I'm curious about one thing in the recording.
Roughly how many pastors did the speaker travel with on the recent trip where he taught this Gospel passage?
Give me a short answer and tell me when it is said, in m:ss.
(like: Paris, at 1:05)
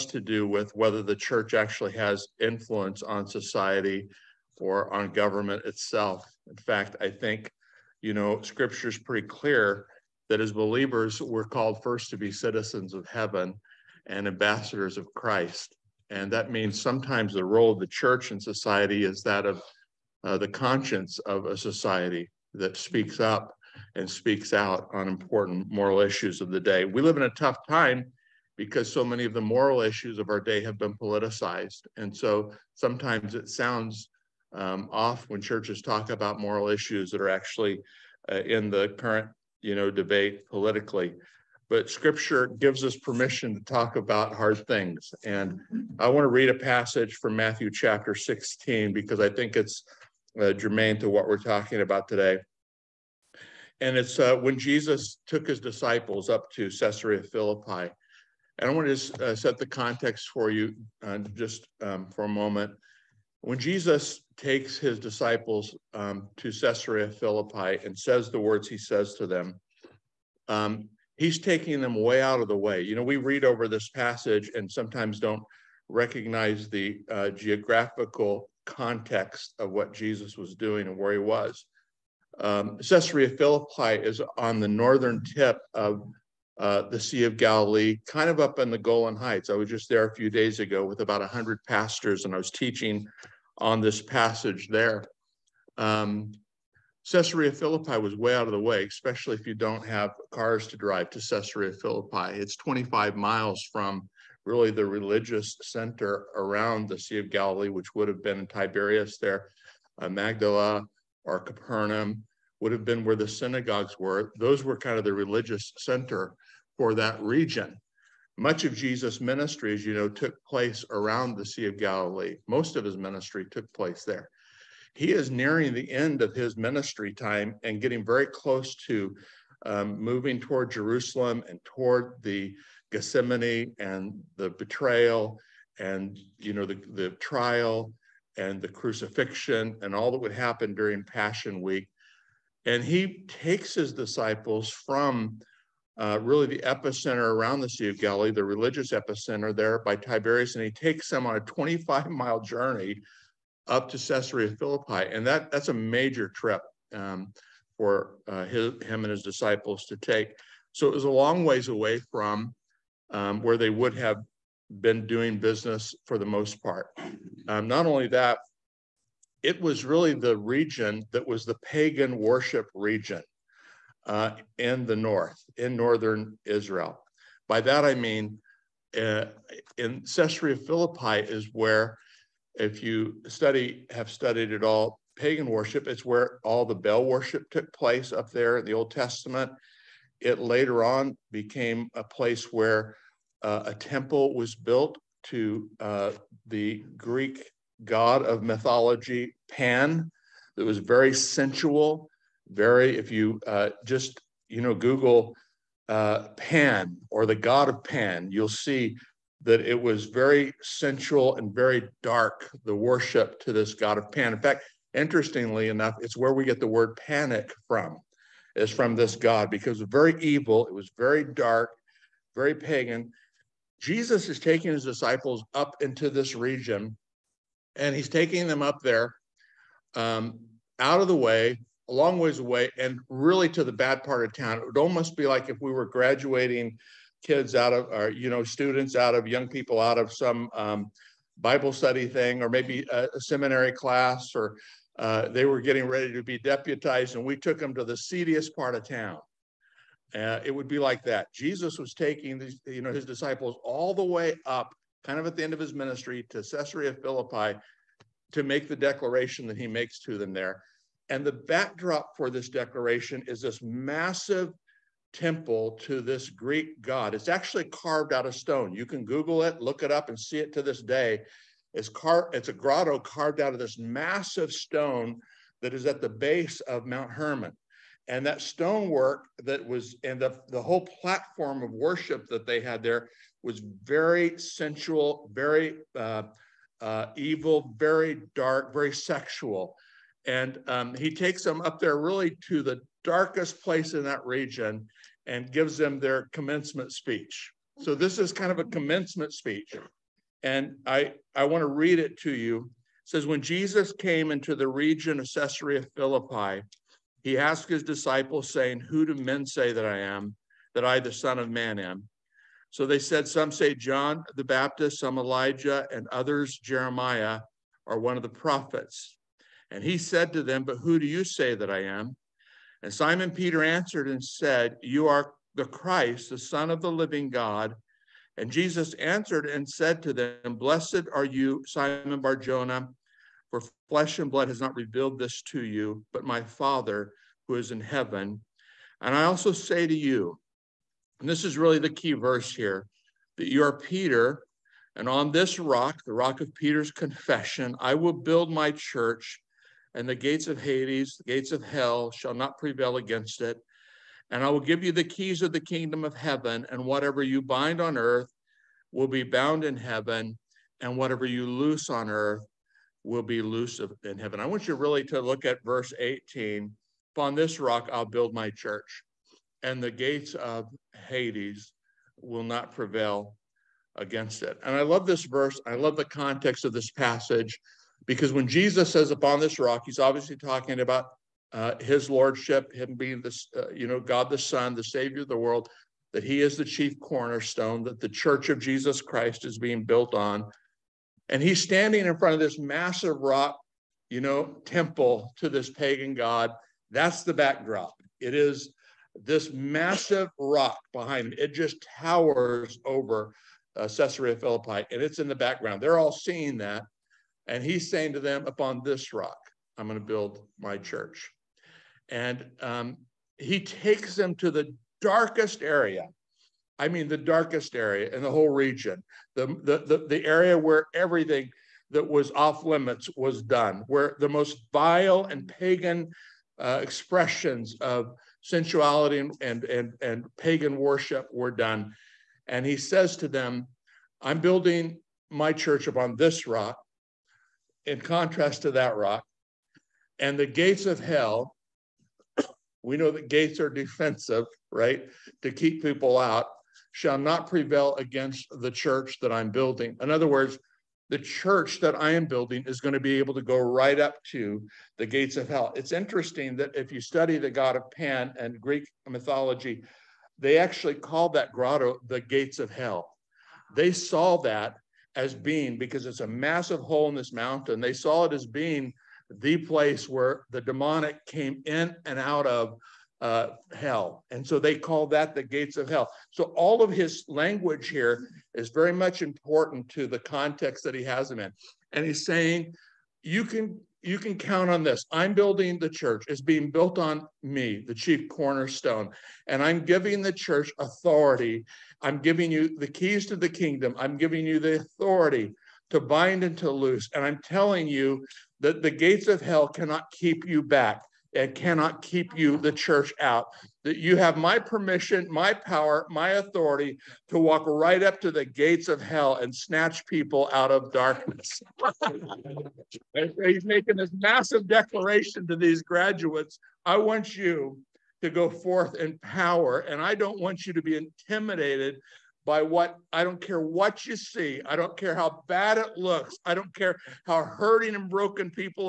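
100, at 1:31.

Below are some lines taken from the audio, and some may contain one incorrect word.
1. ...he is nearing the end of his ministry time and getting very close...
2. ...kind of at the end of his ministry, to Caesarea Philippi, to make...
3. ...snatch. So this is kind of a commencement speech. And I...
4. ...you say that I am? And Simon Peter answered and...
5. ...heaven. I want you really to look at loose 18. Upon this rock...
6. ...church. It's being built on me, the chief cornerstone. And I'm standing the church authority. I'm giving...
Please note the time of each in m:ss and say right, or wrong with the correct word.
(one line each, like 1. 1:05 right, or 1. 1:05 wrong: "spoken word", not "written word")
1. 2:04 right
2. 4:15 right
3. 4:56 wrong: "speech", not "snatch"
4. 5:21 right
5. 6:04 wrong: "verse", not "loose"
6. 8:05 wrong: "giving", not "standing".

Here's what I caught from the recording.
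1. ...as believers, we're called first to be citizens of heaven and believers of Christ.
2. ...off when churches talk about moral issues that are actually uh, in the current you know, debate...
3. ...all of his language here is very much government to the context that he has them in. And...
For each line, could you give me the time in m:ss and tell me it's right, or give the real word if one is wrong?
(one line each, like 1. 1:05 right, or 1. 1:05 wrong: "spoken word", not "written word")
1. 0:10 wrong: "ambassadors", not "believers"
2. 0:34 right
3. 7:56 wrong: "important", not "government".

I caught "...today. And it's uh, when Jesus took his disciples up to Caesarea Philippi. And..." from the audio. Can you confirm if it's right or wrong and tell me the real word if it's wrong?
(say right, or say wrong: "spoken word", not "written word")
right.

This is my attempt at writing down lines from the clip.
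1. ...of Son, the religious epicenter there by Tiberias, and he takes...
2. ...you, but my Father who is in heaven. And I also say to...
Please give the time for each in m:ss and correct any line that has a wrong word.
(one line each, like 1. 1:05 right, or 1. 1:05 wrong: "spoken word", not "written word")
1. 2:27 wrong: "Galilee", not "Son"
2. 5:35 right.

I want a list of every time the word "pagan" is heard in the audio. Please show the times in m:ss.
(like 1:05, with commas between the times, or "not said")
2:51, 3:05, 3:42, 6:35, 7:05, 7:10.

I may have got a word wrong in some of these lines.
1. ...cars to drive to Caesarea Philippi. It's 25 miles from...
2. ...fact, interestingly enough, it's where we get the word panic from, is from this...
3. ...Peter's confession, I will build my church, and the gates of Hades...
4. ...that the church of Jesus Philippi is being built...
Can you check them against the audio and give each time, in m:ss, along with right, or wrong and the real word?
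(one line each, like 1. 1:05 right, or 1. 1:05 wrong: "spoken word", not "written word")
1. 1:40 right
2. 3:34 right
3. 5:46 right
4. 6:27 wrong: "Christ", not "Philippi".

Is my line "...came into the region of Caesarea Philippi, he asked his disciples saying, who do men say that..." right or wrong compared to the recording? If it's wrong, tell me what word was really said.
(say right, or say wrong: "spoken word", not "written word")
right.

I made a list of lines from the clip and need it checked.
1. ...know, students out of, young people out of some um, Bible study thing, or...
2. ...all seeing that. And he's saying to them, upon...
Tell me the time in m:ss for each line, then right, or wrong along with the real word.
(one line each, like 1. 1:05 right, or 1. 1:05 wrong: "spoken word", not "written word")
1. 3:58 right
2. 6:45 right.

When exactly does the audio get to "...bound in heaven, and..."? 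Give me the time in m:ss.
5:59.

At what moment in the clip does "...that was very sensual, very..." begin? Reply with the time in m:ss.
3:20.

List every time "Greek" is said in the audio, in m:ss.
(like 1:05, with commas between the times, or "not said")
3:16, 4:26, 7:38.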